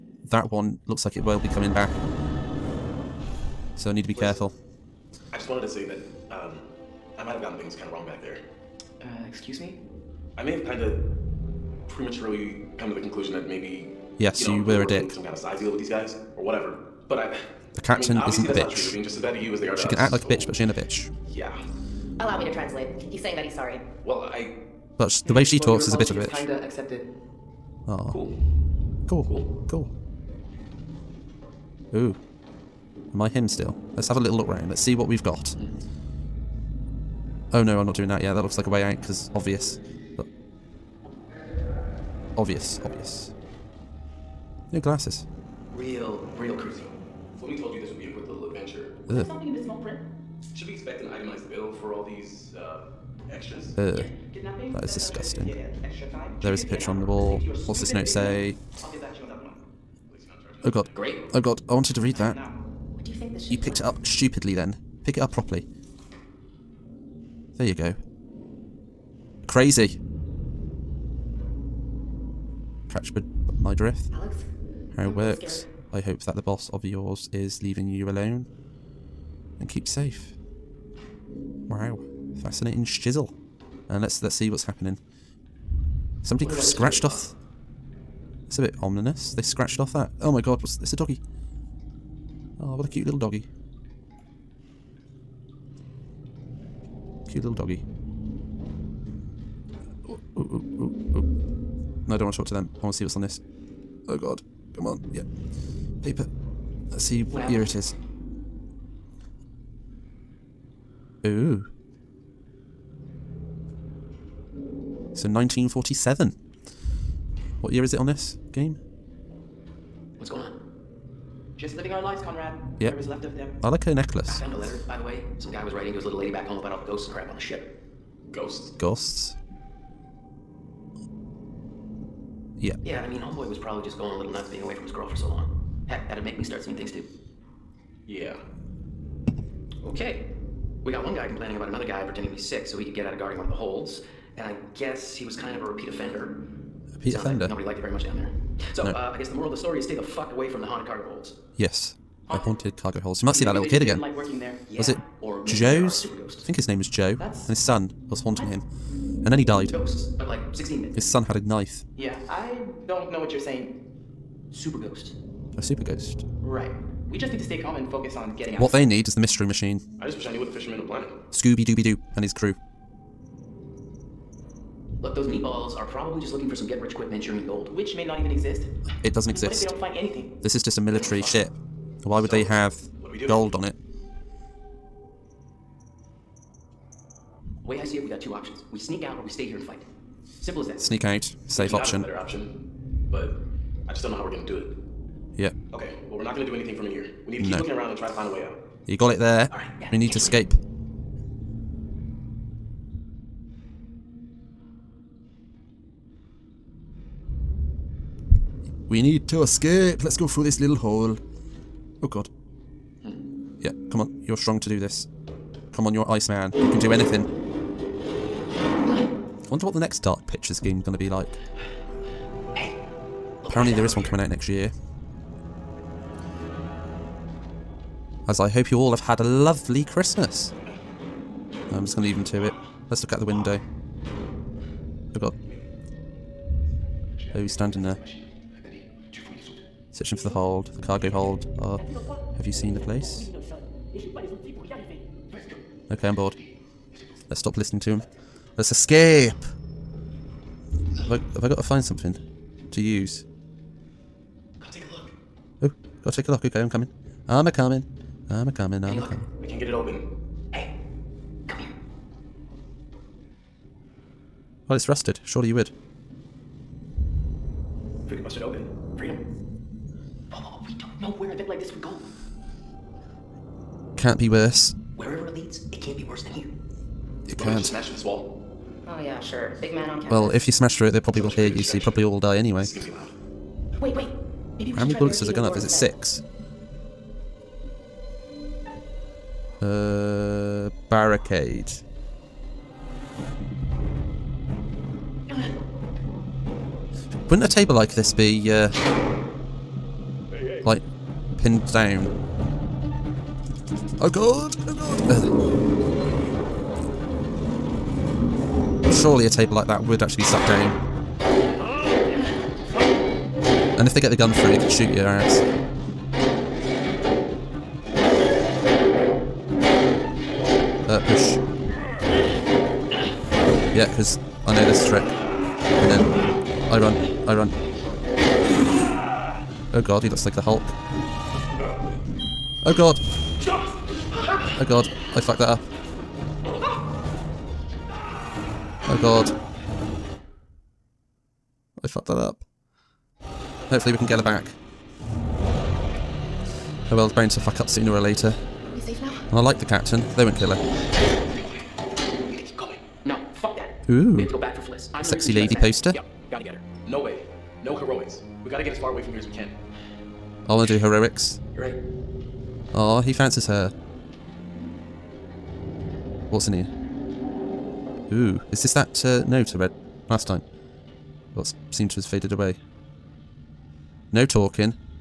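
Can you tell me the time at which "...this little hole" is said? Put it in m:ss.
3:30.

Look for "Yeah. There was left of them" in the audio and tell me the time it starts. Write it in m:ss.
2:02.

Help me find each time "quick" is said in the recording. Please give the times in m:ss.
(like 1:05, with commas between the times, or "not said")
0:48, 2:56.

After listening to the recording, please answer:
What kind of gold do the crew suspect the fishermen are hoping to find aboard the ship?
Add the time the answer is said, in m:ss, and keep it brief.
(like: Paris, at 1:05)
Manchurian gold, at 2:57.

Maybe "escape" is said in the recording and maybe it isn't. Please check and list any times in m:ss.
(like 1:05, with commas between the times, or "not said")
3:20, 3:29, 4:08.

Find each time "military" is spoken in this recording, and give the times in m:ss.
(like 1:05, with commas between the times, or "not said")
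3:00.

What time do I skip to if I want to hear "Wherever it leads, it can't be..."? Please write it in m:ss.
4:34.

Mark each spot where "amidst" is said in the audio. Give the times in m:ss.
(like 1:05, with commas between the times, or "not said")
not said.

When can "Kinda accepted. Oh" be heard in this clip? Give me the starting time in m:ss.
0:26.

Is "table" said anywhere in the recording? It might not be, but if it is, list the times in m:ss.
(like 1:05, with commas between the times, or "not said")
4:57, 5:09.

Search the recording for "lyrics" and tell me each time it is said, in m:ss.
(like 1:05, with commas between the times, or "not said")
not said.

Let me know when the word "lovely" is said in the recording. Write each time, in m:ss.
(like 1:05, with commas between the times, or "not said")
3:49.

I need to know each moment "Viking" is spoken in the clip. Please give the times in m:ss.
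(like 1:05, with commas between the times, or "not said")
not said.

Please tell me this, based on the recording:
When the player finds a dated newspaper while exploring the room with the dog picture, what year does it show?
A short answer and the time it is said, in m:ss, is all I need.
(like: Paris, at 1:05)
1947, at 1:55.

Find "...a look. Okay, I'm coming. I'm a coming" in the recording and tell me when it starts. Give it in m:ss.
4:16.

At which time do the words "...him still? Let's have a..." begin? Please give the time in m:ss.
0:33.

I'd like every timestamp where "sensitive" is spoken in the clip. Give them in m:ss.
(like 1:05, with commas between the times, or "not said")
not said.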